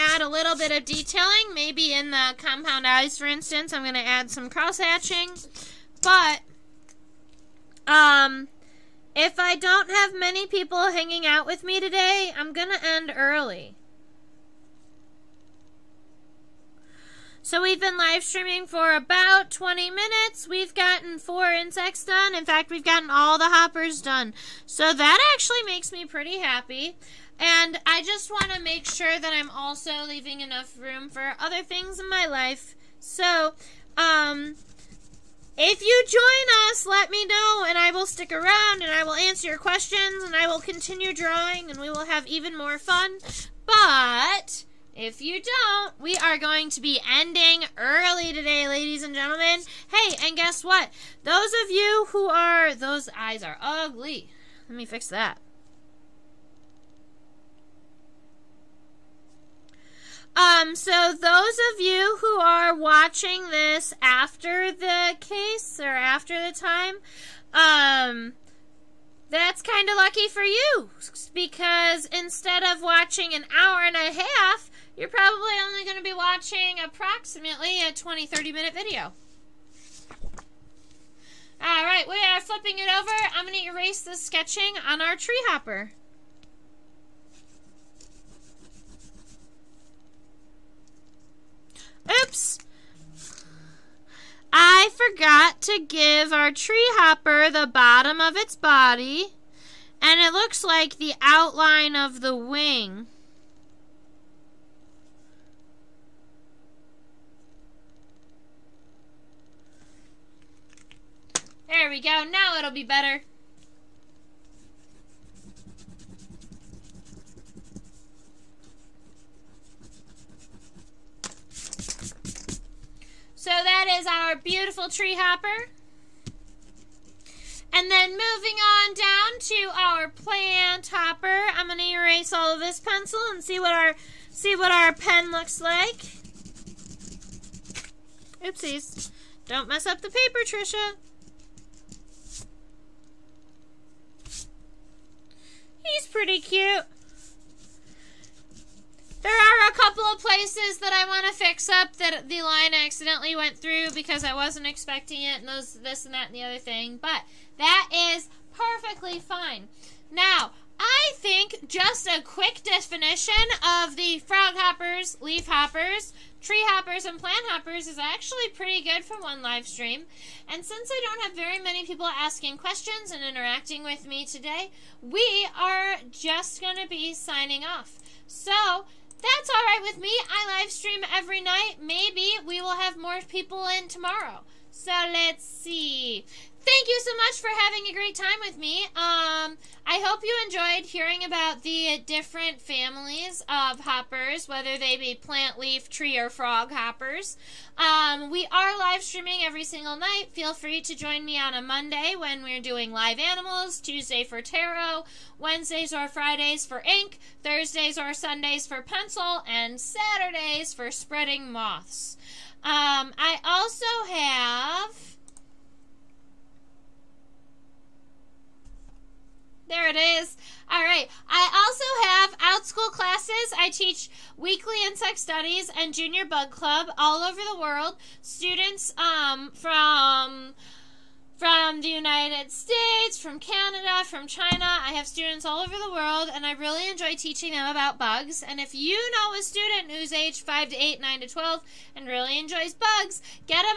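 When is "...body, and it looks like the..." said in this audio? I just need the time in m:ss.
1:38.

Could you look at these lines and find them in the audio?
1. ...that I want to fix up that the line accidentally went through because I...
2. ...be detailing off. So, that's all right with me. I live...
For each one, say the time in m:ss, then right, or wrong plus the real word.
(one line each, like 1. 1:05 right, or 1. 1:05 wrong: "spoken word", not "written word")
1. 2:30 right
2. 2:56 wrong: "signing", not "detailing".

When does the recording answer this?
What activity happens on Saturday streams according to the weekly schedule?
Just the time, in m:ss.
3:30.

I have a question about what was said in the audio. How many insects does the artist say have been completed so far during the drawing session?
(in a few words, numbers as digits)
4.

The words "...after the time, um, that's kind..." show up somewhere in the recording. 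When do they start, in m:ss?
1:05.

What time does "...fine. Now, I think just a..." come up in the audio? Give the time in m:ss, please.
2:39.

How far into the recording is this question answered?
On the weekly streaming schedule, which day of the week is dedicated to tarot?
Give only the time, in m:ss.
3:23.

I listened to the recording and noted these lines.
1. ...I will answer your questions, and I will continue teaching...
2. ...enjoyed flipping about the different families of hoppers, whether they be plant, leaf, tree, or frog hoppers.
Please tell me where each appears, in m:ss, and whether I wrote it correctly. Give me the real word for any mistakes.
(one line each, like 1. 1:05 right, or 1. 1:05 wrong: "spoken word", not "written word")
1. 0:38 wrong: "drawing", not "teaching"
2. 3:10 wrong: "hearing", not "flipping".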